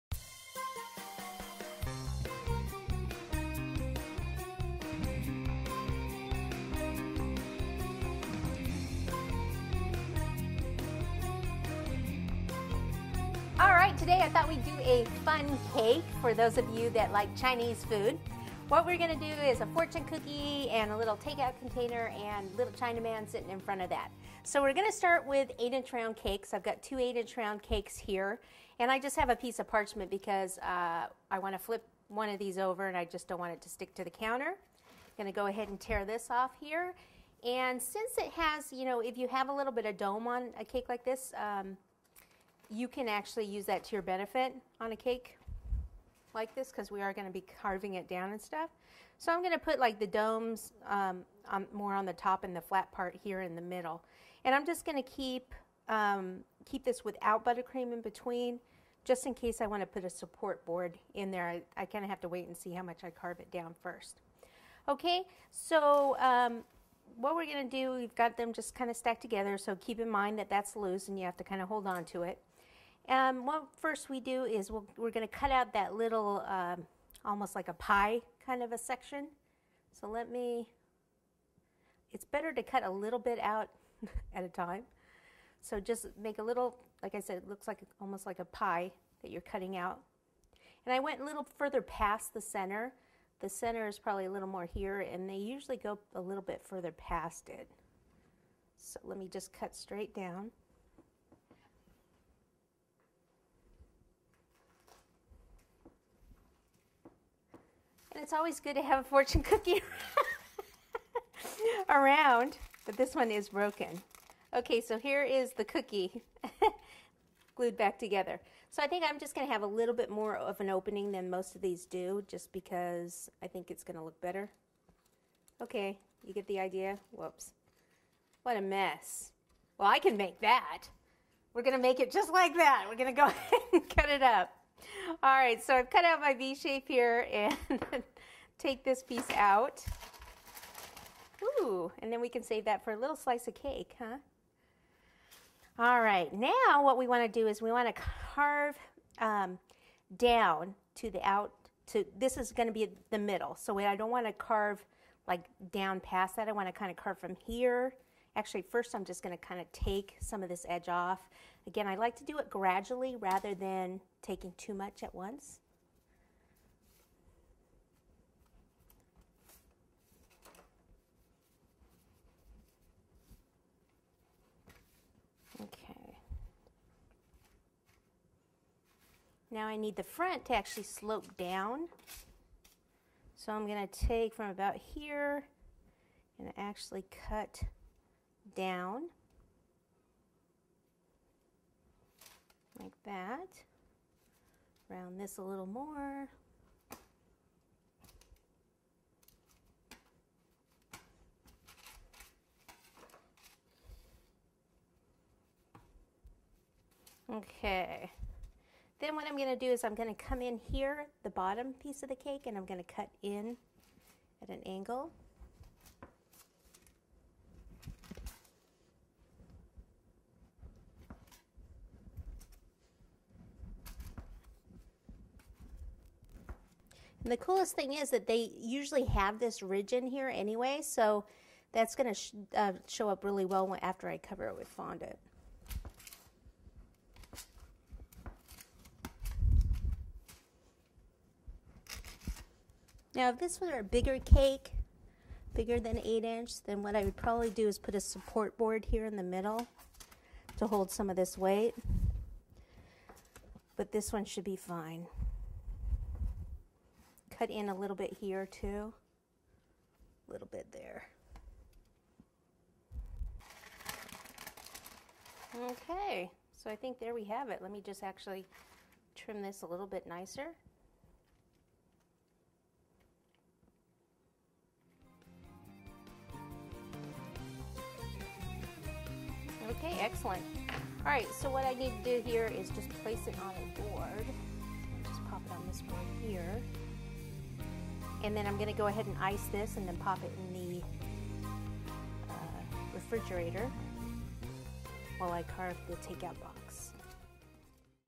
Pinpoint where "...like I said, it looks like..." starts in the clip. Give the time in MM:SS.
01:27.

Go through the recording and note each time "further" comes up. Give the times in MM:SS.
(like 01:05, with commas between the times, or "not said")
01:31, 01:36.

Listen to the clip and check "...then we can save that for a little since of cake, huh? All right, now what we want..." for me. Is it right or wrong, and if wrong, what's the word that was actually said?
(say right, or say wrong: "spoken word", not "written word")
wrong: "slice", not "since".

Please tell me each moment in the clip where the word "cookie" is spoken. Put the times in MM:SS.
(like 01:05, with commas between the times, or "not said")
00:20, 01:49, 01:55.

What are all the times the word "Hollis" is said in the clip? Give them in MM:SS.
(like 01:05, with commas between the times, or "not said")
not said.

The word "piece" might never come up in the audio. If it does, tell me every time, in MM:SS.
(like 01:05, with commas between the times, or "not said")
00:29, 02:19, 03:31.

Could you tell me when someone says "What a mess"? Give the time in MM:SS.
02:08.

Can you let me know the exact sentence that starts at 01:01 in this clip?
I, I kind of have to wait and see how much I carve it down first.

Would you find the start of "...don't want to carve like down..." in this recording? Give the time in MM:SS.
02:33.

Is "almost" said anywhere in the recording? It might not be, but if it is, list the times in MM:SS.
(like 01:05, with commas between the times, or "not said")
01:17, 01:27.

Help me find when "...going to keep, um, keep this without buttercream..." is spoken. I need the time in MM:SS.
00:54.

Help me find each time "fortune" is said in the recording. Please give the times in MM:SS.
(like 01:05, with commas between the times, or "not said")
00:19, 01:49.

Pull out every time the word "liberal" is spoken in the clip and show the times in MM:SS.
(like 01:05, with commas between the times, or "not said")
not said.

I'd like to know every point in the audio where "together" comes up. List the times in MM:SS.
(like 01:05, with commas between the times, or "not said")
01:09, 01:57.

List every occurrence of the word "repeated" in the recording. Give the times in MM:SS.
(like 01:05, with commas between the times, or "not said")
not said.